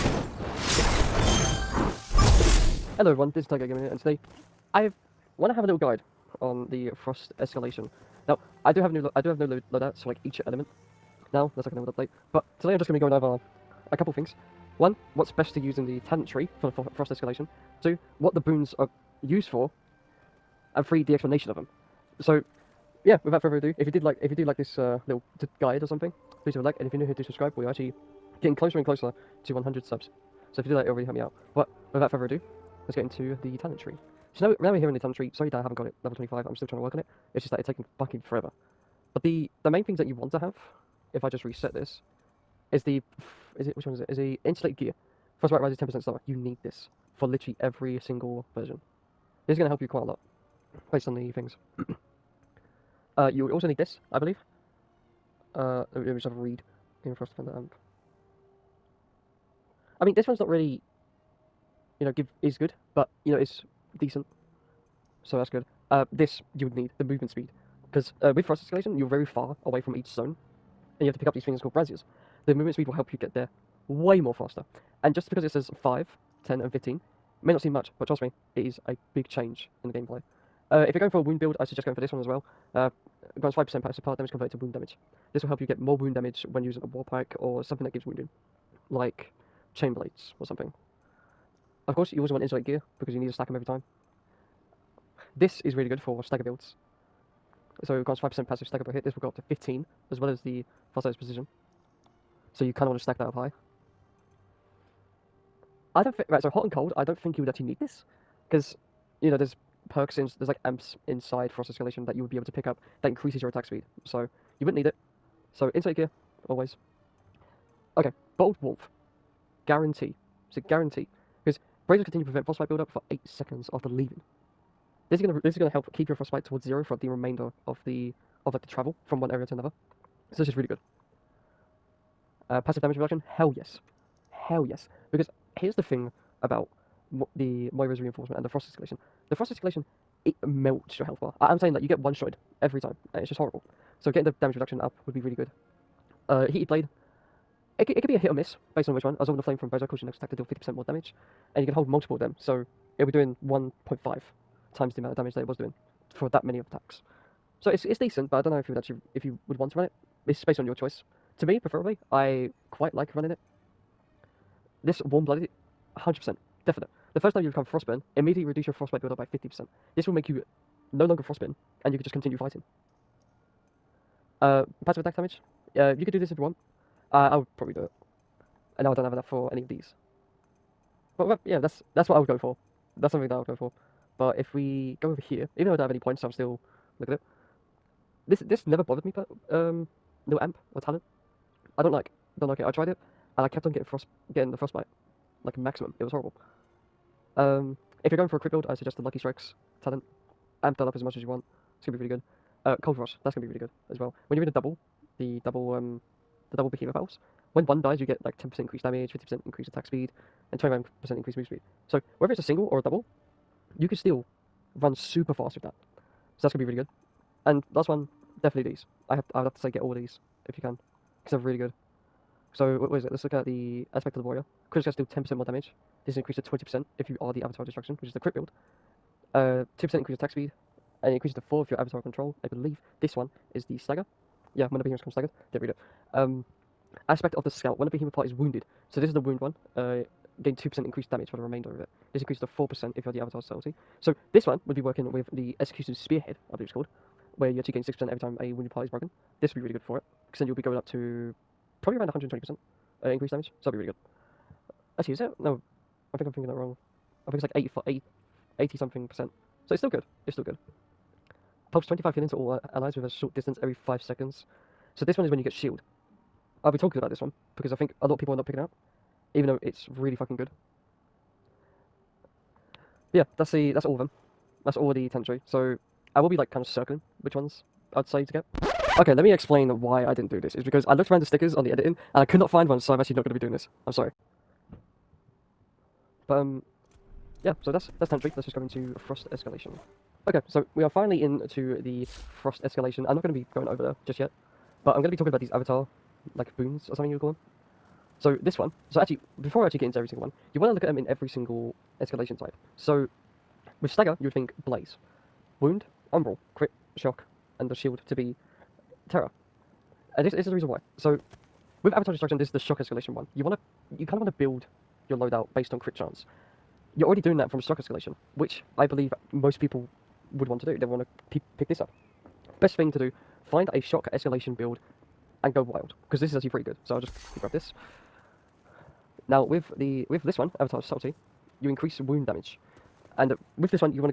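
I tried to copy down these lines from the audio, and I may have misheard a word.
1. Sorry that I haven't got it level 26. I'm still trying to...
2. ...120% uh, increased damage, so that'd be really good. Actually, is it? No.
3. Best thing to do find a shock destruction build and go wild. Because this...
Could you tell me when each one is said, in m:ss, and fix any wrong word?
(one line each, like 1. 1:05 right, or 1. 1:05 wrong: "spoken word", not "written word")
1. 0:35 wrong: "25", not "26"
2. 4:12 right
3. 5:22 wrong: "escalation", not "destruction".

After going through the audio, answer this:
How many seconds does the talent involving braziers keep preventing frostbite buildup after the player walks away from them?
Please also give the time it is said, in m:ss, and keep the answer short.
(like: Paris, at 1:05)
8, at 2:03.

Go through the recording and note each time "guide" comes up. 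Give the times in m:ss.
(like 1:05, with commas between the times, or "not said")
0:05, 0:25.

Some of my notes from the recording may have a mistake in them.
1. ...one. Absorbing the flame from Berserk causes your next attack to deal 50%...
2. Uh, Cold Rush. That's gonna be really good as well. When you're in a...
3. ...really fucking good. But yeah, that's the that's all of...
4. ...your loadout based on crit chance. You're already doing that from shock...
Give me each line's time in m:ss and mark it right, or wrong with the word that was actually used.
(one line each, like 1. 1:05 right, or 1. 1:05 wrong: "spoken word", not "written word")
1. 2:29 right
2. 3:22 right
3. 4:29 right
4. 5:15 right.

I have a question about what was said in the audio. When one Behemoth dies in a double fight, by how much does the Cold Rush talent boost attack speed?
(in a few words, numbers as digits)
50%.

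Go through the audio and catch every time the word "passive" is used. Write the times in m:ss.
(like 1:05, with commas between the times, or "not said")
1:23, 1:38, 2:12, 2:54.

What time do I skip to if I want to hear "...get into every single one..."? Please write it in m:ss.
4:59.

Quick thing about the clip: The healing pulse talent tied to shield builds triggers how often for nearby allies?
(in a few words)
Every 5 seconds.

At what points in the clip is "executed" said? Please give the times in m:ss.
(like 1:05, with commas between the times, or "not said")
4:05.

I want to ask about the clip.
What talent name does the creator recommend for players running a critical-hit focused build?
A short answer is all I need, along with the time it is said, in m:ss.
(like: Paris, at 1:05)
Lucky Strikes, at 3:19.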